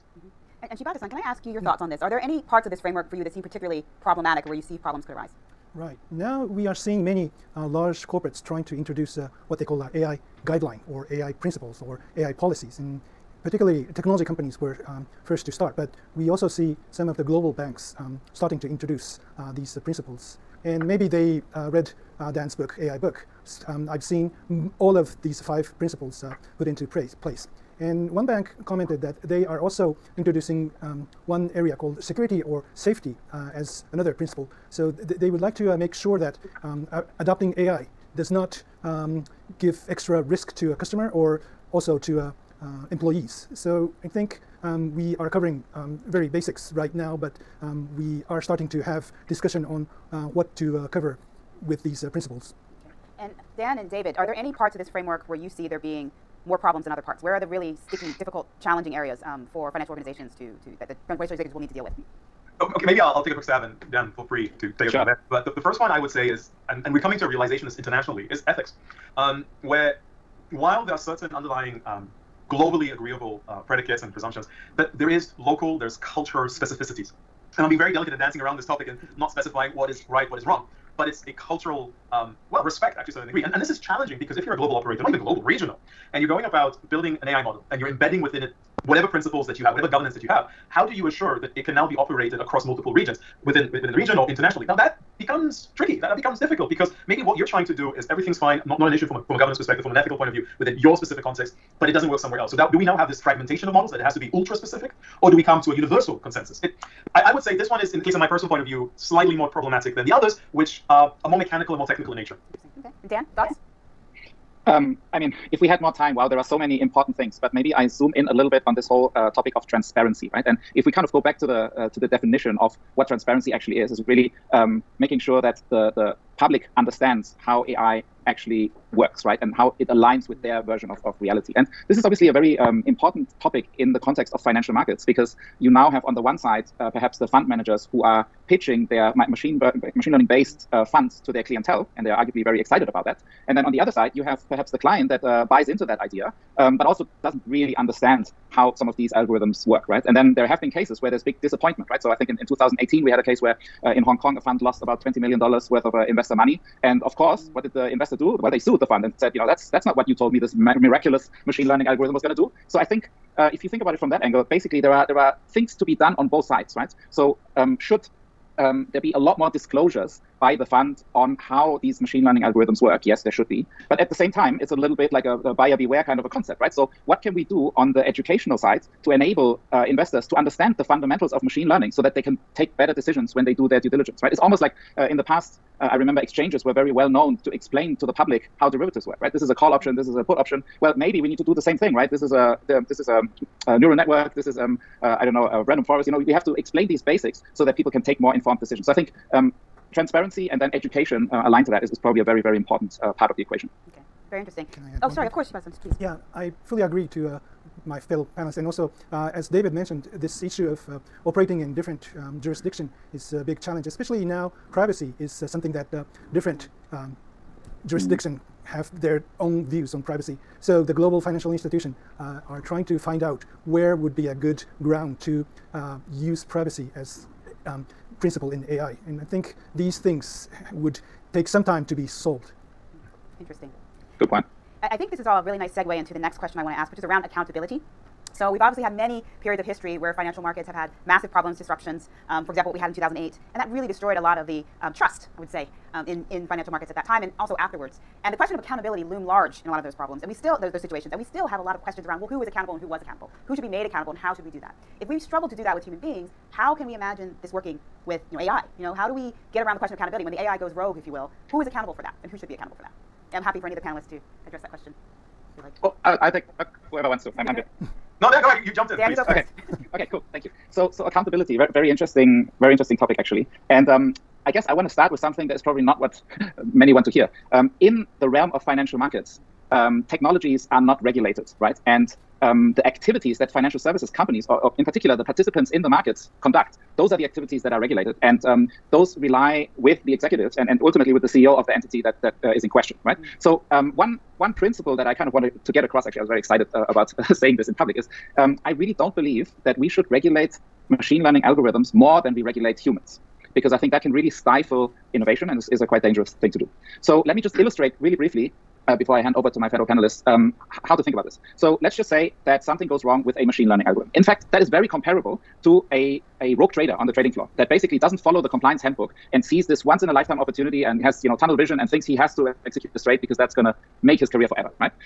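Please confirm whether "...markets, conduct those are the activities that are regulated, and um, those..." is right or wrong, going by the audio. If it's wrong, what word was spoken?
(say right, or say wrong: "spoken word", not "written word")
right.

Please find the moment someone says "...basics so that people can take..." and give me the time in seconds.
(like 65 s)
197 s.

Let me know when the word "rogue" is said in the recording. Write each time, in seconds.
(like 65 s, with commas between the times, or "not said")
260 s, 316 s.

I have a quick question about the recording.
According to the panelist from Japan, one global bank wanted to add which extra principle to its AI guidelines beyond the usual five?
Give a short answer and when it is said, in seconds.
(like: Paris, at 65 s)
security or safety, at 32 s.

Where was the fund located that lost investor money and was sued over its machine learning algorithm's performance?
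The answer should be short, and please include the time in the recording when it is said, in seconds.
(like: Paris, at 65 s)
Hong Kong, at 154 s.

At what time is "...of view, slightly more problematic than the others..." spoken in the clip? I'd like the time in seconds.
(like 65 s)
108 s.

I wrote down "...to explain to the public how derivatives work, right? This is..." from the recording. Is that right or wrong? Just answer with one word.
right.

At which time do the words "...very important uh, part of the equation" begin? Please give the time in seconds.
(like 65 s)
202 s.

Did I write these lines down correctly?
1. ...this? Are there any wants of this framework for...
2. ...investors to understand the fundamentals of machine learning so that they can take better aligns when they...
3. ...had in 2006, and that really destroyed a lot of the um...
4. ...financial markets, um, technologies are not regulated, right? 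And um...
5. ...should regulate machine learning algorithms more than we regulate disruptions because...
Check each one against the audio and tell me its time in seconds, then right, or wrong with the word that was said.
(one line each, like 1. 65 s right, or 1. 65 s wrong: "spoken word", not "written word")
1. 1 s wrong: "parts", not "wants"
2. 179 s wrong: "decisions", not "aligns"
3. 242 s wrong: "2008", not "2006"
4. 278 s right
5. 299 s wrong: "humans", not "disruptions".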